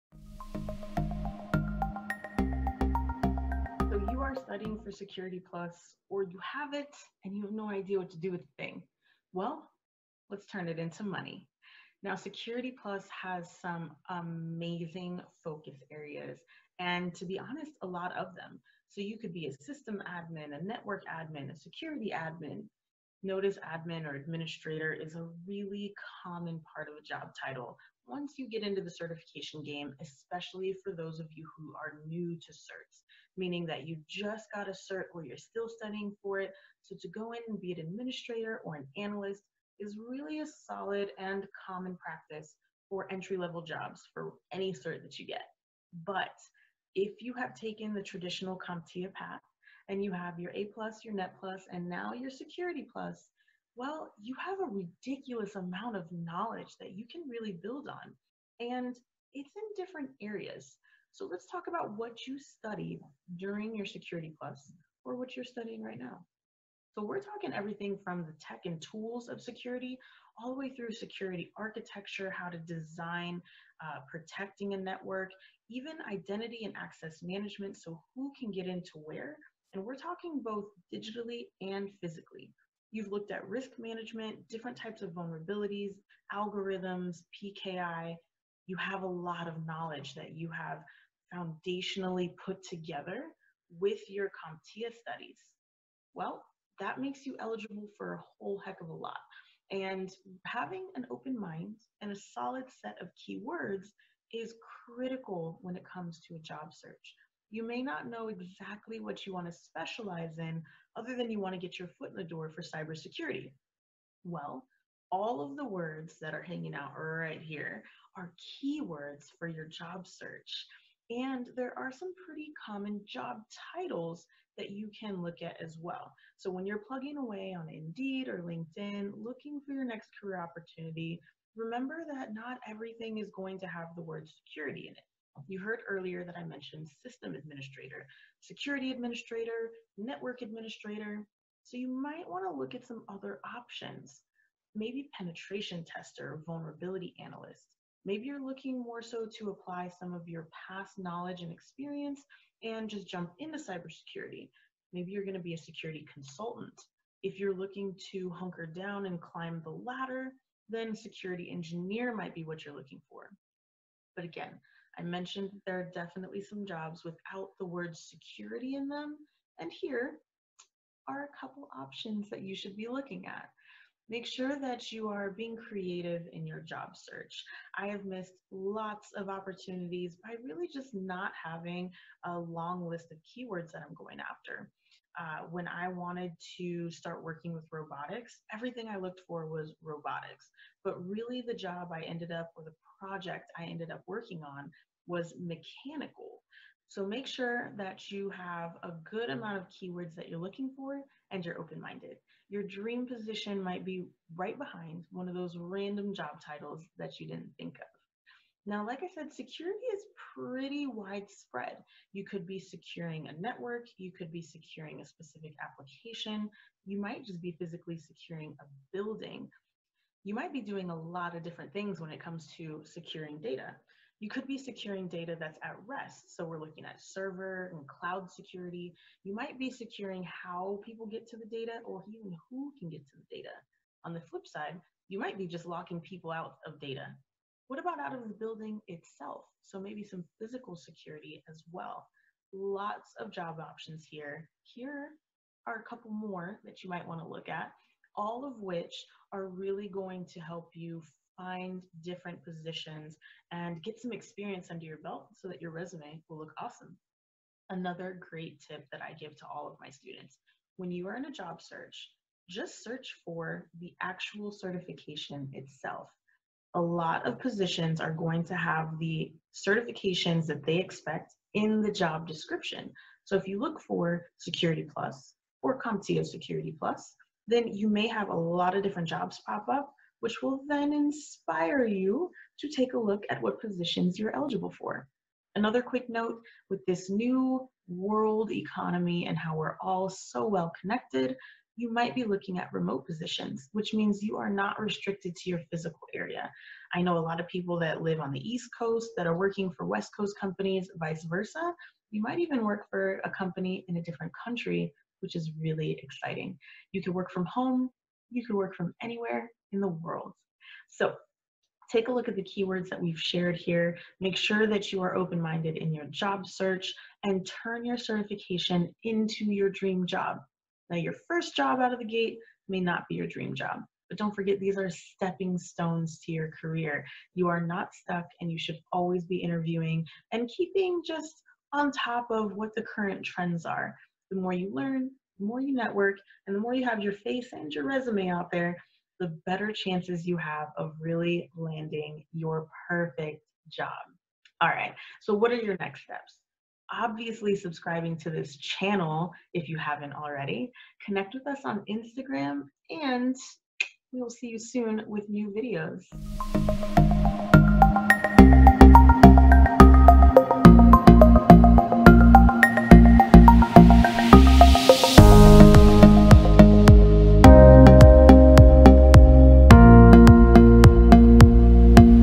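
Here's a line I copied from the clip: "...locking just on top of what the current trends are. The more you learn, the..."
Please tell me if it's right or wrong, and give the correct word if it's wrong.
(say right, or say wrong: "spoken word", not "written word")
wrong: "keeping", not "locking".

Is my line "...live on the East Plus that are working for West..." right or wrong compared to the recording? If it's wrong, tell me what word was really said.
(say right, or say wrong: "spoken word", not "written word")
wrong: "Coast", not "Plus".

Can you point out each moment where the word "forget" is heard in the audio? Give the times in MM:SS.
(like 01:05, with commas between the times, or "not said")
05:24.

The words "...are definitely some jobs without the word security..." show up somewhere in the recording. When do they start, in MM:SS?
02:45.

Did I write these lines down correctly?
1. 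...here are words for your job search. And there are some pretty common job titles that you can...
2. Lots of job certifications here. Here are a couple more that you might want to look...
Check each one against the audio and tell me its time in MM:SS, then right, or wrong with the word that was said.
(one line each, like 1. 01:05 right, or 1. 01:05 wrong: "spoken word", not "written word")
1. 01:57 wrong: "keywords", not "words"
2. 04:02 wrong: "options", not "certifications".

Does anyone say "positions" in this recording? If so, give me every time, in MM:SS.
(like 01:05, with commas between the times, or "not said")
03:23, 04:12, 04:27, 04:43, 04:53.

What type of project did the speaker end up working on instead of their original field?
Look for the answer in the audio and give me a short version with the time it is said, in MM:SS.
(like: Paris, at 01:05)
Mechanical, at 03:15.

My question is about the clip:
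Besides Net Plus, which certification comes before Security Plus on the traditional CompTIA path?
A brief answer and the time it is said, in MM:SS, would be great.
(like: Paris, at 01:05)
A plus, at 00:50.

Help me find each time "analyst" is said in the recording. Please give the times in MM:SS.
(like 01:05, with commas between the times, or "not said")
00:38, 02:27.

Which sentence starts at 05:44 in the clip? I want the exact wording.
All right, so what are your next steps?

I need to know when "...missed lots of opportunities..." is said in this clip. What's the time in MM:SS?
02:58.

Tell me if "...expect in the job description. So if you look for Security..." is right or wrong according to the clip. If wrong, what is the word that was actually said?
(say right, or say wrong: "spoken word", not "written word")
right.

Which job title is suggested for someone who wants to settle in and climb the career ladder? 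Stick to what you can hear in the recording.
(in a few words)
Security engineer.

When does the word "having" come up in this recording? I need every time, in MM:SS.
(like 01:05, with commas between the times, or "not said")
01:40, 03:01.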